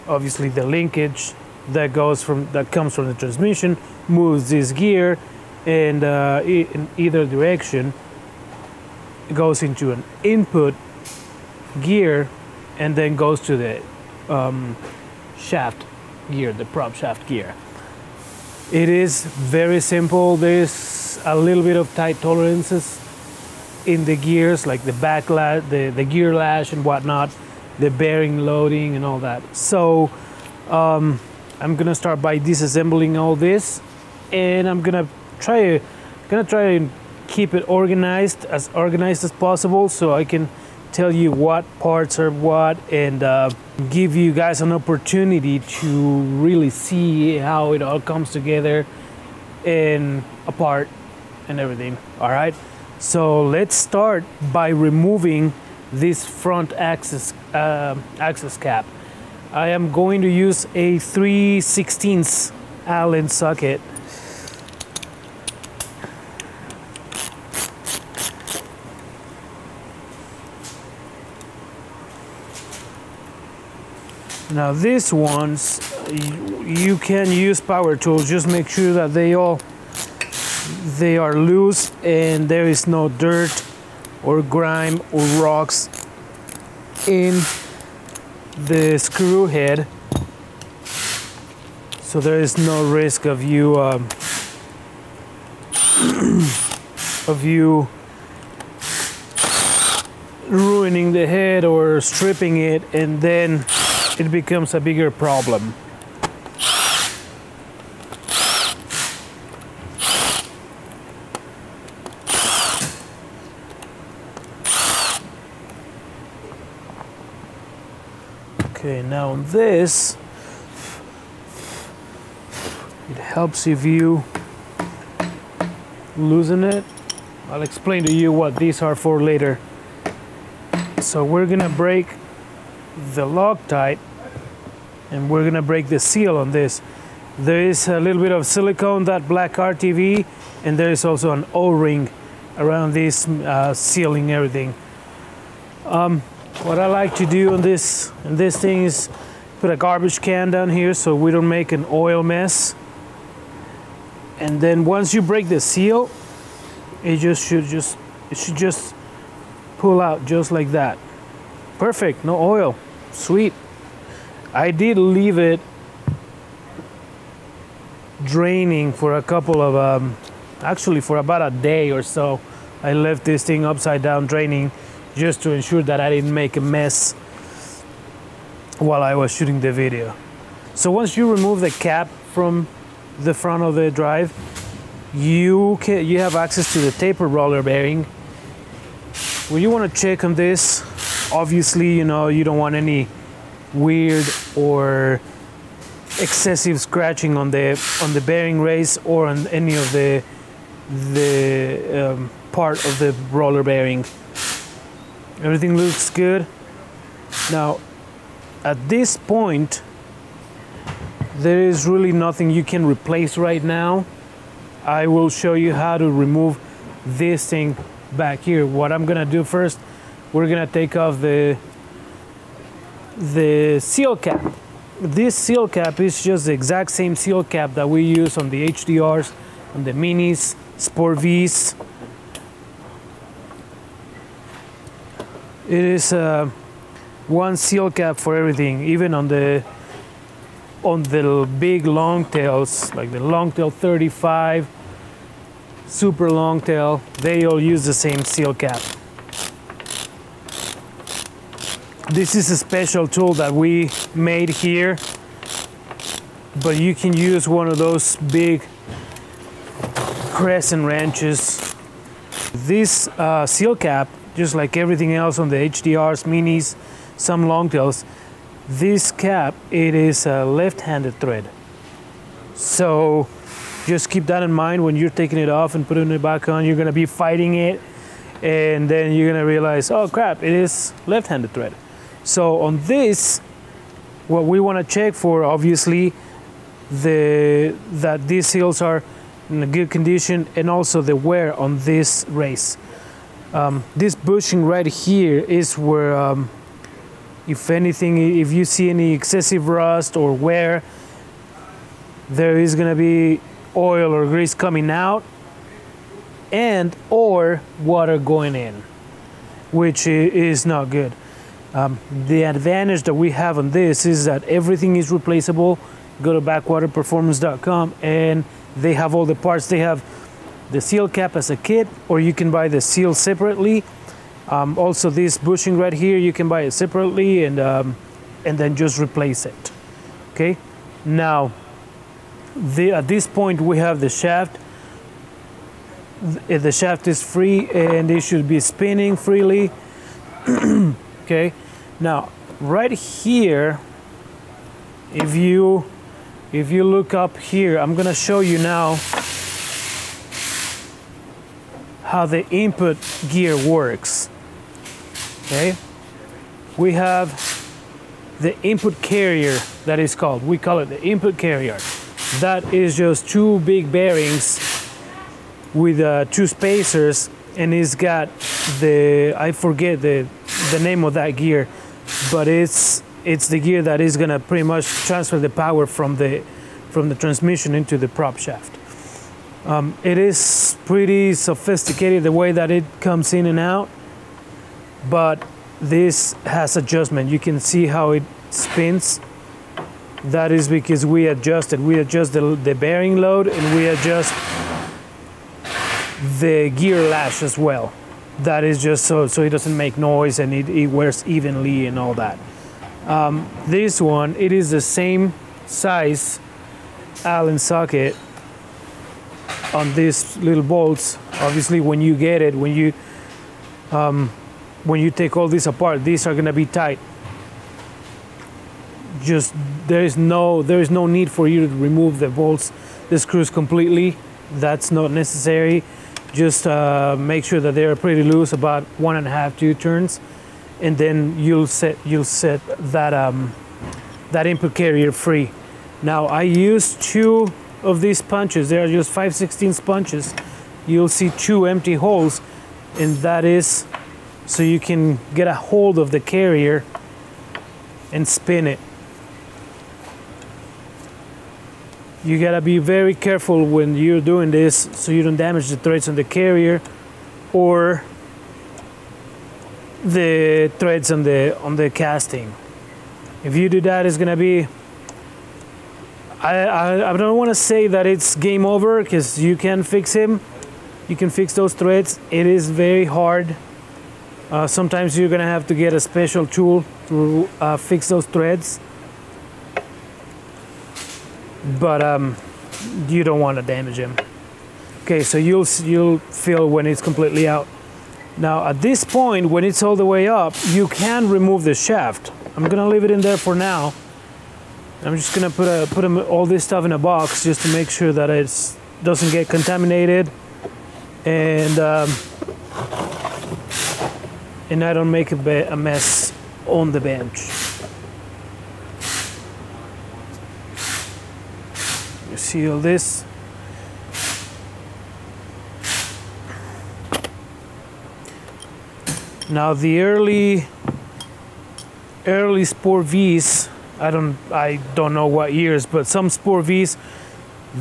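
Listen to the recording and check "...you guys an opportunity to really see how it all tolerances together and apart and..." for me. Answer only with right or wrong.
wrong.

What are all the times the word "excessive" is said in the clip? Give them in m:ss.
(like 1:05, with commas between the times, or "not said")
3:16, 4:59.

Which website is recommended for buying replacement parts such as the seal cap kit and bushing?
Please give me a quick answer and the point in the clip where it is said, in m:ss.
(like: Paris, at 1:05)
backwaterperformance.com, at 5:16.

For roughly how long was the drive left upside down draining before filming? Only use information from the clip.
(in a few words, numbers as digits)
about a day.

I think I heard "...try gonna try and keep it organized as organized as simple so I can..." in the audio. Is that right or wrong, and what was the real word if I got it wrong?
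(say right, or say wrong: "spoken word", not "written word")
wrong: "possible", not "simple".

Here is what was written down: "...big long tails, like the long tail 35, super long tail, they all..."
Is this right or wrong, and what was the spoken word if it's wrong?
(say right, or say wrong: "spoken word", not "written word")
right.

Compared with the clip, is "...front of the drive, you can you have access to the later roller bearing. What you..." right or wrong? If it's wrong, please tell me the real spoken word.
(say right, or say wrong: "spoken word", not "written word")
wrong: "taper", not "later".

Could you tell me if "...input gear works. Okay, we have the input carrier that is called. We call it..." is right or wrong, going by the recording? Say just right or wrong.
right.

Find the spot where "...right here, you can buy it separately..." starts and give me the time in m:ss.
5:25.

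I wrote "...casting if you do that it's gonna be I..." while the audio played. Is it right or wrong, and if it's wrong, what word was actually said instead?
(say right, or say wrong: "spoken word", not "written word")
right.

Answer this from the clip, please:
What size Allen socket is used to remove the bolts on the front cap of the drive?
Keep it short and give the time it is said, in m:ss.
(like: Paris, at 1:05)
3, at 1:00.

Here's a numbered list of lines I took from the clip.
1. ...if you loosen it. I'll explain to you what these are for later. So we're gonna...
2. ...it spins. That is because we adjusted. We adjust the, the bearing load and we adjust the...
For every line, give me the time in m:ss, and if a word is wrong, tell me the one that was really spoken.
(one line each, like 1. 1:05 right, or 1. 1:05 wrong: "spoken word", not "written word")
1. 2:03 right
2. 6:28 right.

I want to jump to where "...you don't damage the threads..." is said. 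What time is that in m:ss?
7:35.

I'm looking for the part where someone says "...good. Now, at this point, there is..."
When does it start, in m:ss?
3:26.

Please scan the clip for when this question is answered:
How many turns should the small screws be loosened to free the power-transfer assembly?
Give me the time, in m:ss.
7:08.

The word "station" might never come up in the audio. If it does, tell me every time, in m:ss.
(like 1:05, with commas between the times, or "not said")
not said.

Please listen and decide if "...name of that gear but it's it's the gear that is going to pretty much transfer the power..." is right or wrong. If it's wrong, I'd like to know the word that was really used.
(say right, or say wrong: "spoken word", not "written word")
right.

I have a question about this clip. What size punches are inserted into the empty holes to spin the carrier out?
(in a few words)
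5.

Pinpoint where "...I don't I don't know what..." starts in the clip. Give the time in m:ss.
8:43.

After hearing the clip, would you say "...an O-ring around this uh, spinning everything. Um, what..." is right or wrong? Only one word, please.
wrong.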